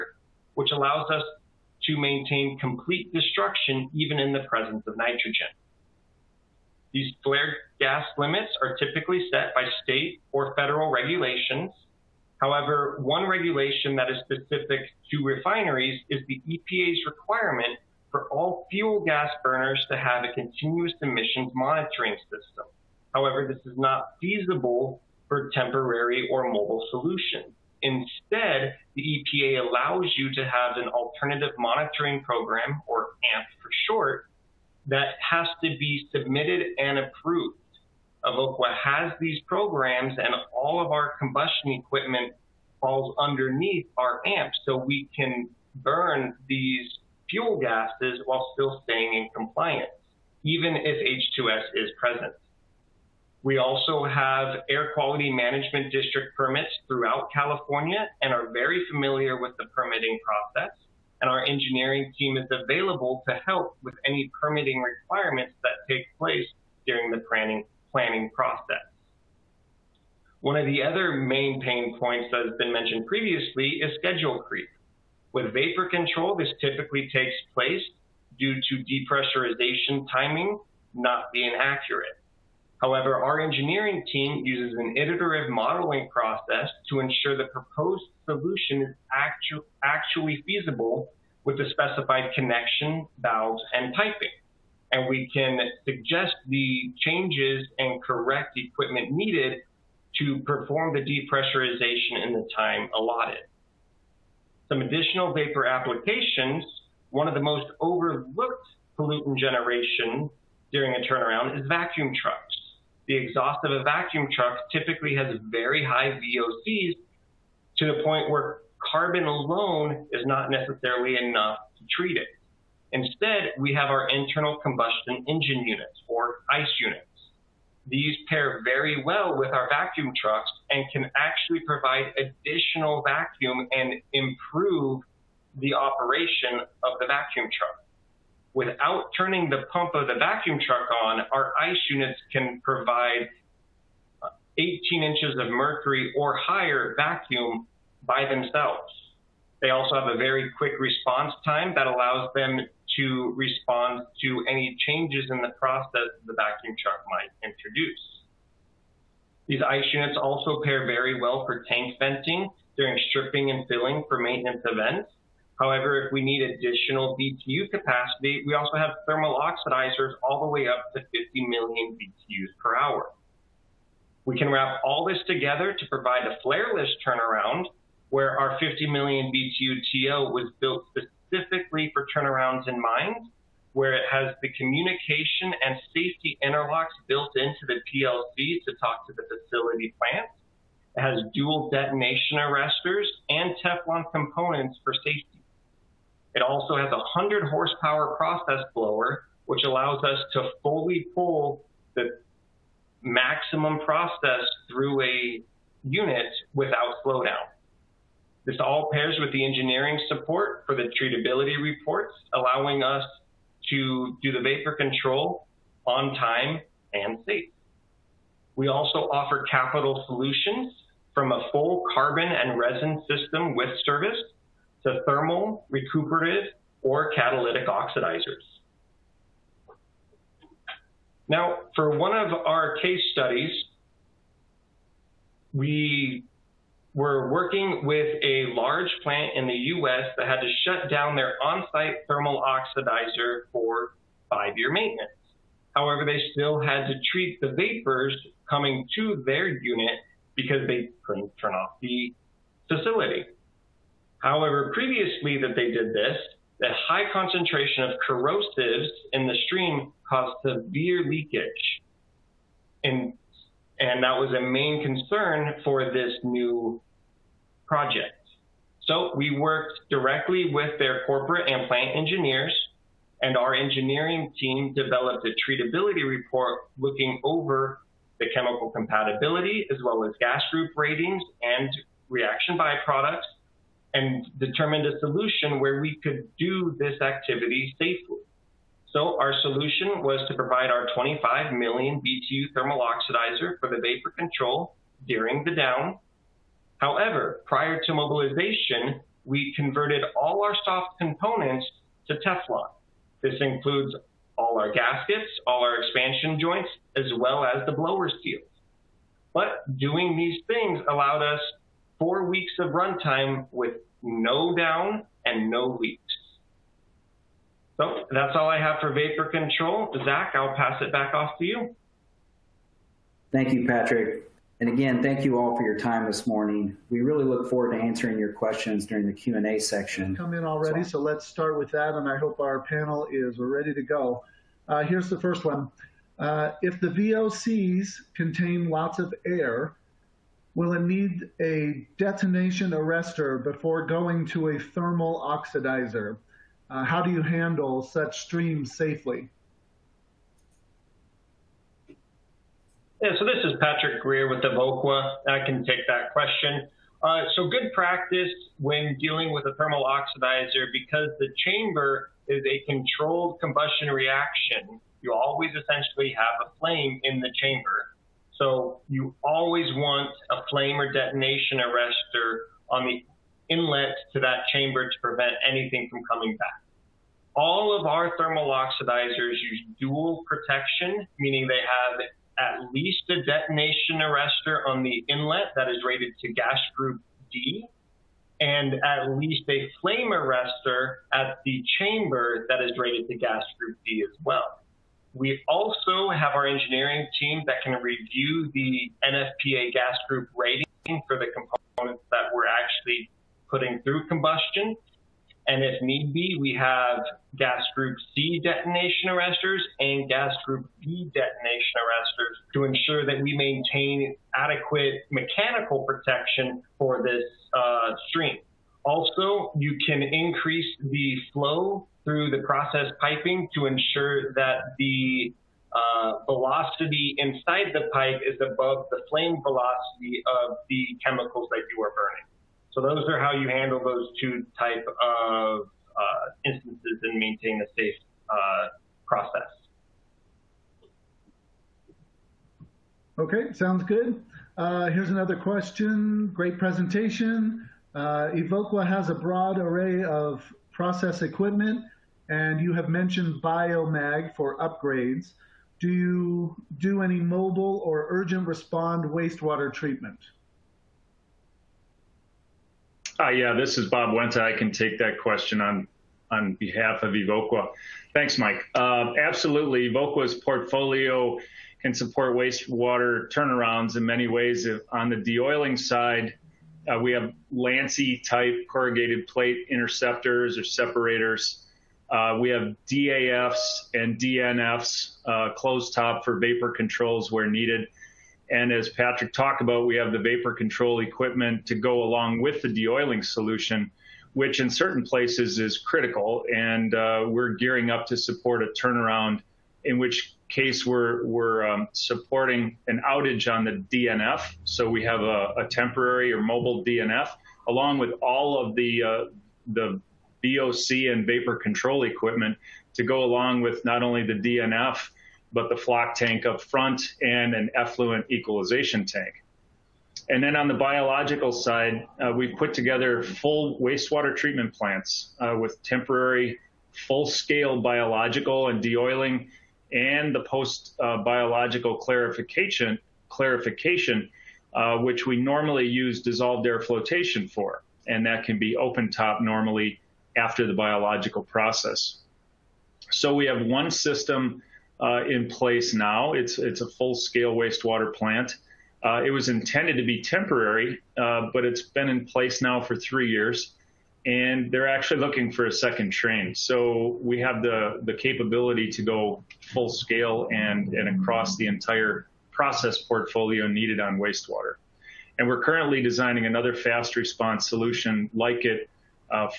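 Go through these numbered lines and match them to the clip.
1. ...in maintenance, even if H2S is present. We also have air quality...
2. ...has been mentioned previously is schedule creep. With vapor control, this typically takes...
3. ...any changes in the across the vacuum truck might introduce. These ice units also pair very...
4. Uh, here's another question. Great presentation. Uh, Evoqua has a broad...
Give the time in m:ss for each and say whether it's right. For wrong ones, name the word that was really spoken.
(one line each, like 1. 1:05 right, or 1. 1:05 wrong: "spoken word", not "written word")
1. 0:49 wrong: "compliance", not "maintenance"
2. 1:12 right
3. 2:34 wrong: "process", not "across"
4. 7:24 right.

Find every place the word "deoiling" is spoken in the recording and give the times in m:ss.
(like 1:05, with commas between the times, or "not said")
7:55, 8:12, 8:48.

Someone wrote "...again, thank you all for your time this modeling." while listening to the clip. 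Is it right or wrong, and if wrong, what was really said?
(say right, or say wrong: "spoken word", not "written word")
wrong: "morning", not "modeling".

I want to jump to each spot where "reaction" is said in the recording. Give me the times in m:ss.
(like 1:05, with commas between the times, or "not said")
4:42, 6:03.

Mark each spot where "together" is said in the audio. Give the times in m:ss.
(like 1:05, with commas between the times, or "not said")
2:55, 8:42.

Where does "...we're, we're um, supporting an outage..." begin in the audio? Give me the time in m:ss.
8:20.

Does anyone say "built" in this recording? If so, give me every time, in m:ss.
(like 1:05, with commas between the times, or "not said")
3:00, 3:07.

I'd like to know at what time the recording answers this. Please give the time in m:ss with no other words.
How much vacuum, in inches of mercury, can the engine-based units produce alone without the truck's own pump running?
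2:24.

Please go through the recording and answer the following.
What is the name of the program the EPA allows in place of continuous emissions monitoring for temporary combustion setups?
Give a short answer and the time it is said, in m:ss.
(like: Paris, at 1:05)
Alternative monitoring program, at 0:30.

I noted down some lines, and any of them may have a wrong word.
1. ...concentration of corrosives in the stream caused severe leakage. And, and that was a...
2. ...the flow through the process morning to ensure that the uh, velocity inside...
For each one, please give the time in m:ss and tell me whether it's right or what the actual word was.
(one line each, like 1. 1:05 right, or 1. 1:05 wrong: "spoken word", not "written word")
1. 4:17 right
2. 7:00 wrong: "piping", not "morning".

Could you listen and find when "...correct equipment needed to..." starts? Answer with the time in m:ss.
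1:38.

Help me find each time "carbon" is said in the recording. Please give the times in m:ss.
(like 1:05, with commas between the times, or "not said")
1:58, 3:41.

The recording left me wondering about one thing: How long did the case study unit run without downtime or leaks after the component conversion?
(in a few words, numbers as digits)
Four weeks.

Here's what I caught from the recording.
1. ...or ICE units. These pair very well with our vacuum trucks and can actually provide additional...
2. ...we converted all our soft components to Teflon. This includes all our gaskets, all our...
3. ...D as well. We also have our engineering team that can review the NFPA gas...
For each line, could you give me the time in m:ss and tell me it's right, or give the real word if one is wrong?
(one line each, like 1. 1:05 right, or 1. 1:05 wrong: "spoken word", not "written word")
1. 2:06 right
2. 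4:59 right
3. 6:33 right.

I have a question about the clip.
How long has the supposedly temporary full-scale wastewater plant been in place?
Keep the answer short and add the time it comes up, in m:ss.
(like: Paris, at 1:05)
Three years, at 9:12.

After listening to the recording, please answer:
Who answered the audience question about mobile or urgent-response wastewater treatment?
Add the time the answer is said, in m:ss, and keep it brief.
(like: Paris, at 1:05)
Bob Wenta, at 7:43.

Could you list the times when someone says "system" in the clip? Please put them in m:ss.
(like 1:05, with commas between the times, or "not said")
0:22, 3:43, 9:03.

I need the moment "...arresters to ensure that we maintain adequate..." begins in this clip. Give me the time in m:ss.
6:51.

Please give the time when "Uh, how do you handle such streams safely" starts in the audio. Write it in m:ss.
5:46.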